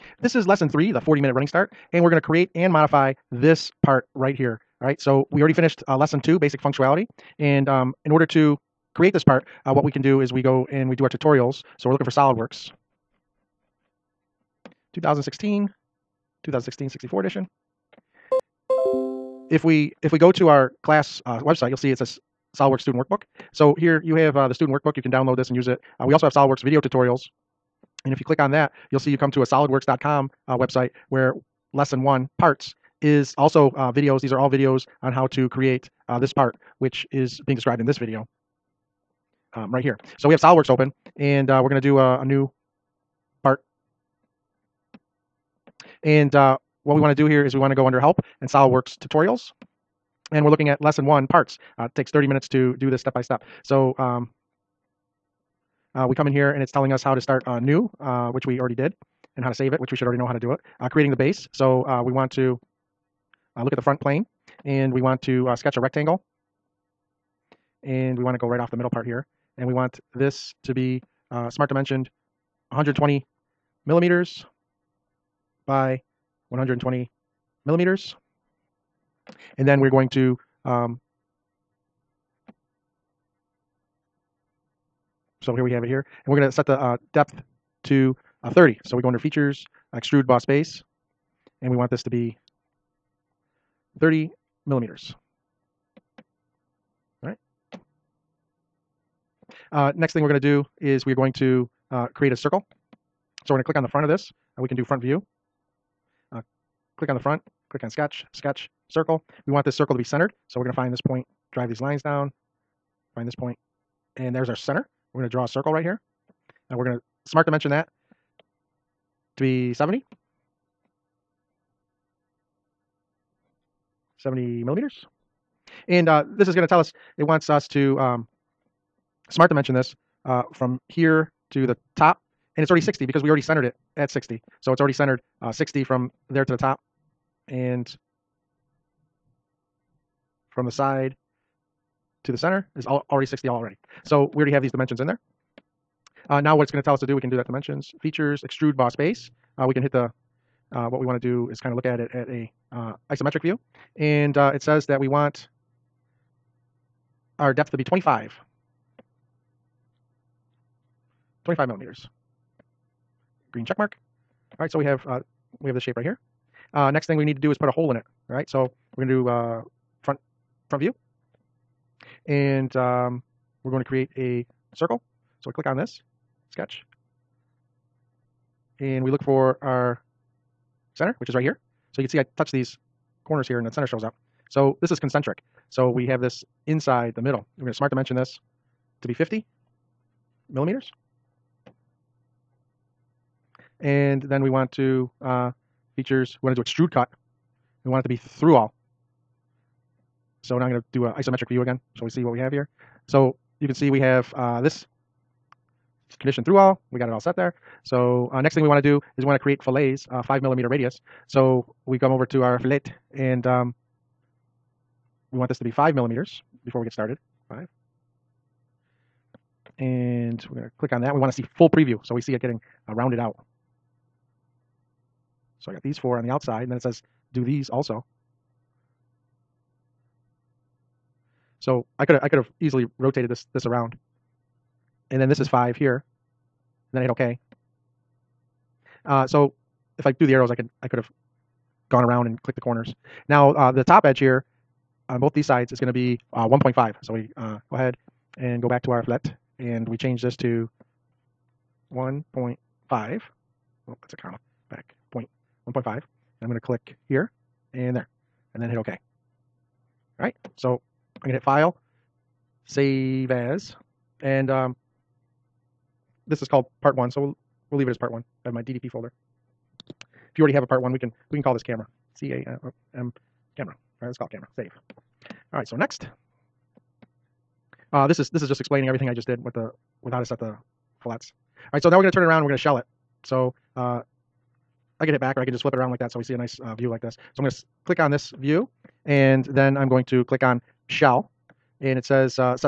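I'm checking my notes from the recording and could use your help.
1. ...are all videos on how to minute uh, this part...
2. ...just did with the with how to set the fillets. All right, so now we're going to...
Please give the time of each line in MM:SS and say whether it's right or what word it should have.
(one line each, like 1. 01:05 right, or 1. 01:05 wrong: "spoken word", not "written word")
1. 00:34 wrong: "create", not "minute"
2. 04:39 right.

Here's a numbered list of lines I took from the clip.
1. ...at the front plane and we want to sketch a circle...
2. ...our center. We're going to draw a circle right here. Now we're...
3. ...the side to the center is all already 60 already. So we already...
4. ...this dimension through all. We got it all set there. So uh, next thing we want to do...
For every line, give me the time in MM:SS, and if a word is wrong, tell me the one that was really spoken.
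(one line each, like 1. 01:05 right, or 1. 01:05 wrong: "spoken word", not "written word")
1. 01:03 wrong: "rectangle", not "circle"
2. 01:54 right
3. 02:20 right
4. 03:24 wrong: "condition", not "dimension".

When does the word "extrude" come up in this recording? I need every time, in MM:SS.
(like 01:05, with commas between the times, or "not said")
01:29, 02:28, 03:16.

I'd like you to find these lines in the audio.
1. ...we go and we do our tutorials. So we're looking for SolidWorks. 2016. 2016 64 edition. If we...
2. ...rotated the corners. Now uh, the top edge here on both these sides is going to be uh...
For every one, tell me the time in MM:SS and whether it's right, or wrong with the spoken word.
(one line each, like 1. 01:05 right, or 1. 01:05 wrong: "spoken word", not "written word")
1. 00:10 right
2. 04:02 wrong: "clicked", not "rotated".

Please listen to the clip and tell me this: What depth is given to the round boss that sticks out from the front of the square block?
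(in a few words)
25 millimeters.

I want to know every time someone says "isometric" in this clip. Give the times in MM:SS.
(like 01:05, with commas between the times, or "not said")
02:33, 03:21.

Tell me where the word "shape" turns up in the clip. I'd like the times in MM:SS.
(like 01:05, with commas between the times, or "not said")
02:45.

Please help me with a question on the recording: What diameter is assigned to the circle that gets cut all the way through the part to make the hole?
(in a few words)
50 millimeters.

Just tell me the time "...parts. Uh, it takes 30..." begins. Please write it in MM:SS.
00:51.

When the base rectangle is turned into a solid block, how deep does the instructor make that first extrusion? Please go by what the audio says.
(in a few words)
30 millimeters.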